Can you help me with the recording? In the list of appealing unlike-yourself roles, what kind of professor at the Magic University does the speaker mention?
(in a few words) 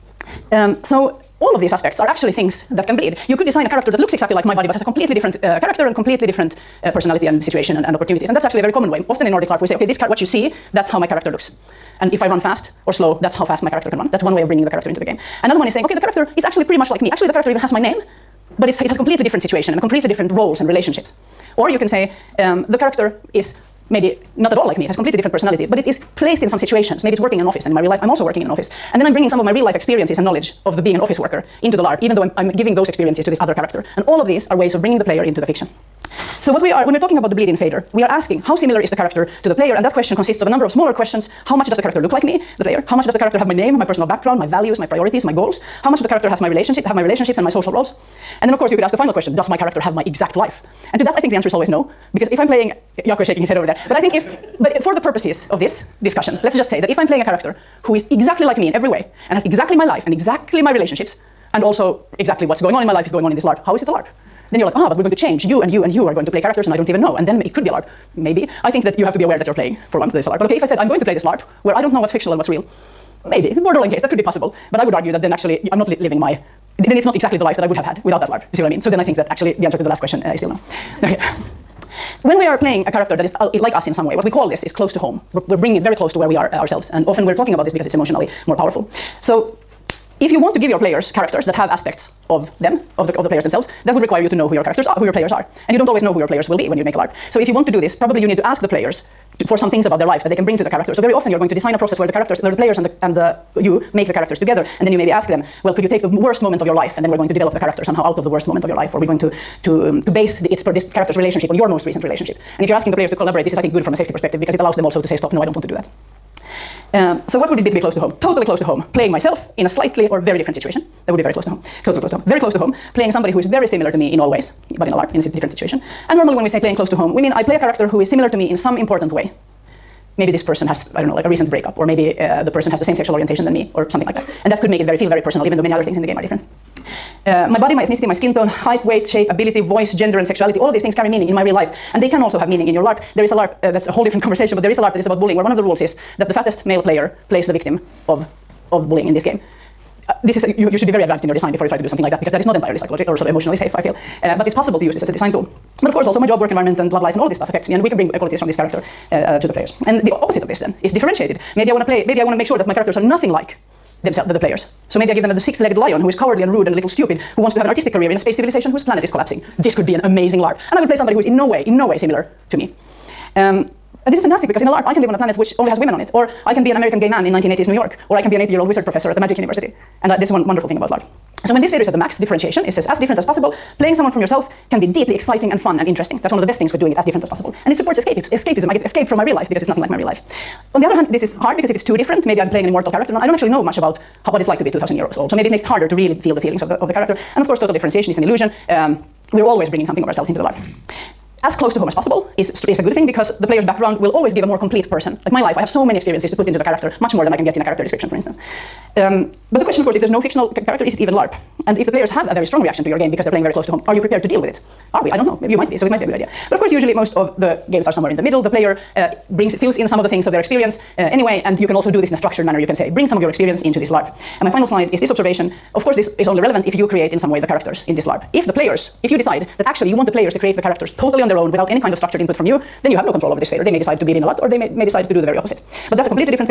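80-year-old wizard professor.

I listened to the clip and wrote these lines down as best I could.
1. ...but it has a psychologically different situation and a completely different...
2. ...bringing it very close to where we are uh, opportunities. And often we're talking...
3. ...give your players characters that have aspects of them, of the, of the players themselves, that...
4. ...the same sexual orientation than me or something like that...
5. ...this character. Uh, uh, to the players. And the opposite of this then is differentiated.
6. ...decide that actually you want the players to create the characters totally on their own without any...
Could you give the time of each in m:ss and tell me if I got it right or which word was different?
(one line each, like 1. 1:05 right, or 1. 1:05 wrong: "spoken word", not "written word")
1. 0:18 wrong: "completely", not "psychologically"
2. 1:25 wrong: "ourselves", not "opportunities"
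3. 1:30 right
4. 2:12 right
5. 2:38 right
6. 3:49 right.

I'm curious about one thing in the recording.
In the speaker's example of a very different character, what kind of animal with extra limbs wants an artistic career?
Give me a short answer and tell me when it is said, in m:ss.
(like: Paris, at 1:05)
six-legged lion, at 2:45.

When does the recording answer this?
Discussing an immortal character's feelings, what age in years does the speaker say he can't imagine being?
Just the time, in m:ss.
3:14.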